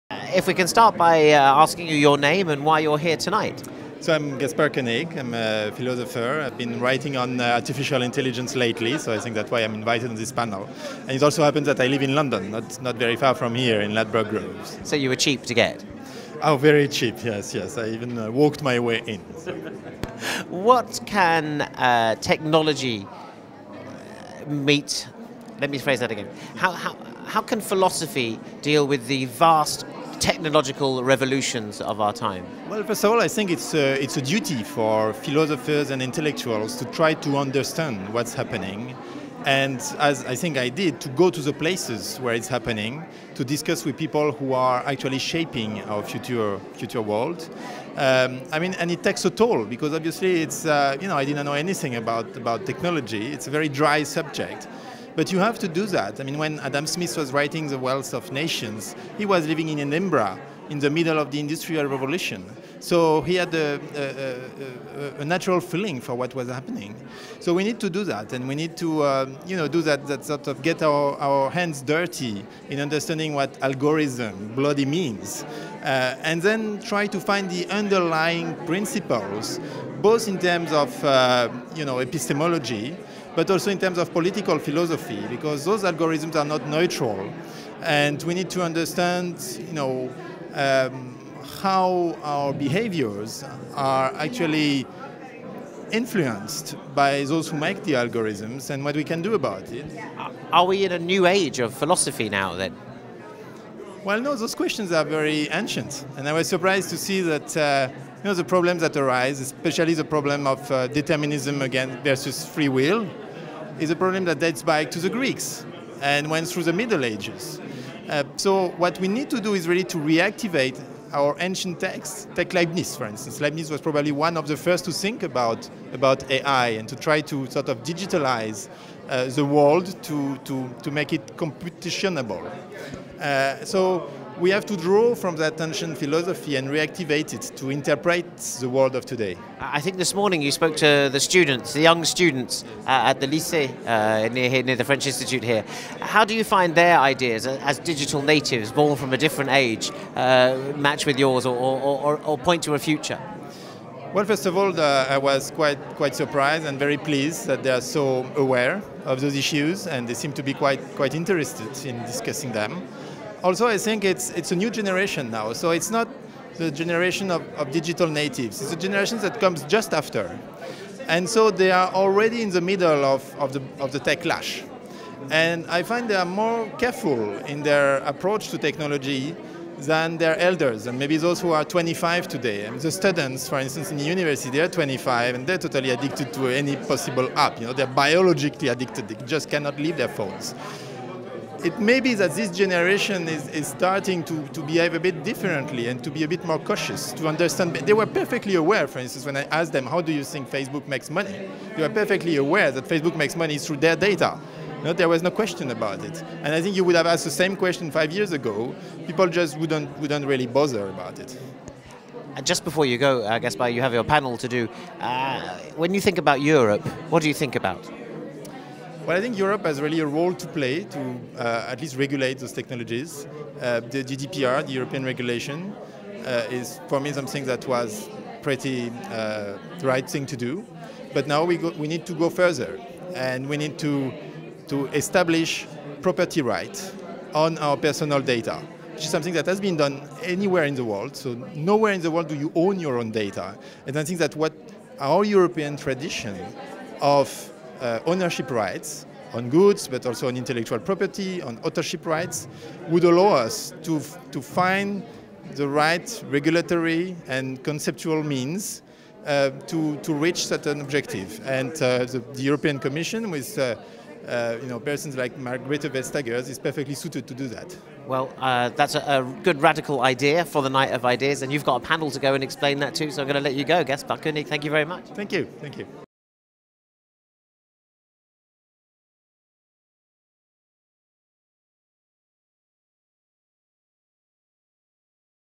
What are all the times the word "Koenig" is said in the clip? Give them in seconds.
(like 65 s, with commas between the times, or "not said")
4 s, 274 s.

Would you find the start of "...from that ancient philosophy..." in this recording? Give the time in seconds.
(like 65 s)
135 s.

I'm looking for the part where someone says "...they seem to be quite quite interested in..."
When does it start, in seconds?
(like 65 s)
160 s.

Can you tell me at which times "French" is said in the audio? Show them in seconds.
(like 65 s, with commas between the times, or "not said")
144 s.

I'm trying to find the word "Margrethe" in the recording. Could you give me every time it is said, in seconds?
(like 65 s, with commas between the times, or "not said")
265 s.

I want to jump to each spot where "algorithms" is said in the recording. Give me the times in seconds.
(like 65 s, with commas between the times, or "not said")
73 s, 85 s, 97 s.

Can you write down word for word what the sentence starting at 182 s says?
I mean, the students, for instance, in the university, they're 25 and they're totally addicted to any possible app.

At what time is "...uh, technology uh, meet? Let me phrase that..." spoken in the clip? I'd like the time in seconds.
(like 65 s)
21 s.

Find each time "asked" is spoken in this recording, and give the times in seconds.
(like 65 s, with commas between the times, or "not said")
199 s, 207 s.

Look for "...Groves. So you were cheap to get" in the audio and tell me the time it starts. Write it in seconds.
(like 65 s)
14 s.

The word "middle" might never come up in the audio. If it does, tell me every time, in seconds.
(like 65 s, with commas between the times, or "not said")
60 s, 116 s, 172 s.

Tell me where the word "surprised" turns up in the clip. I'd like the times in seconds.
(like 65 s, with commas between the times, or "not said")
106 s, 156 s.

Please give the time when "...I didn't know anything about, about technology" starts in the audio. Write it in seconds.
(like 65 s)
51 s.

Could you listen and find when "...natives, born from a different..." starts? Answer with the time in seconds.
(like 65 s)
148 s.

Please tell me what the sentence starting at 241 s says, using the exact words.
So nowhere in the world do you own your own data.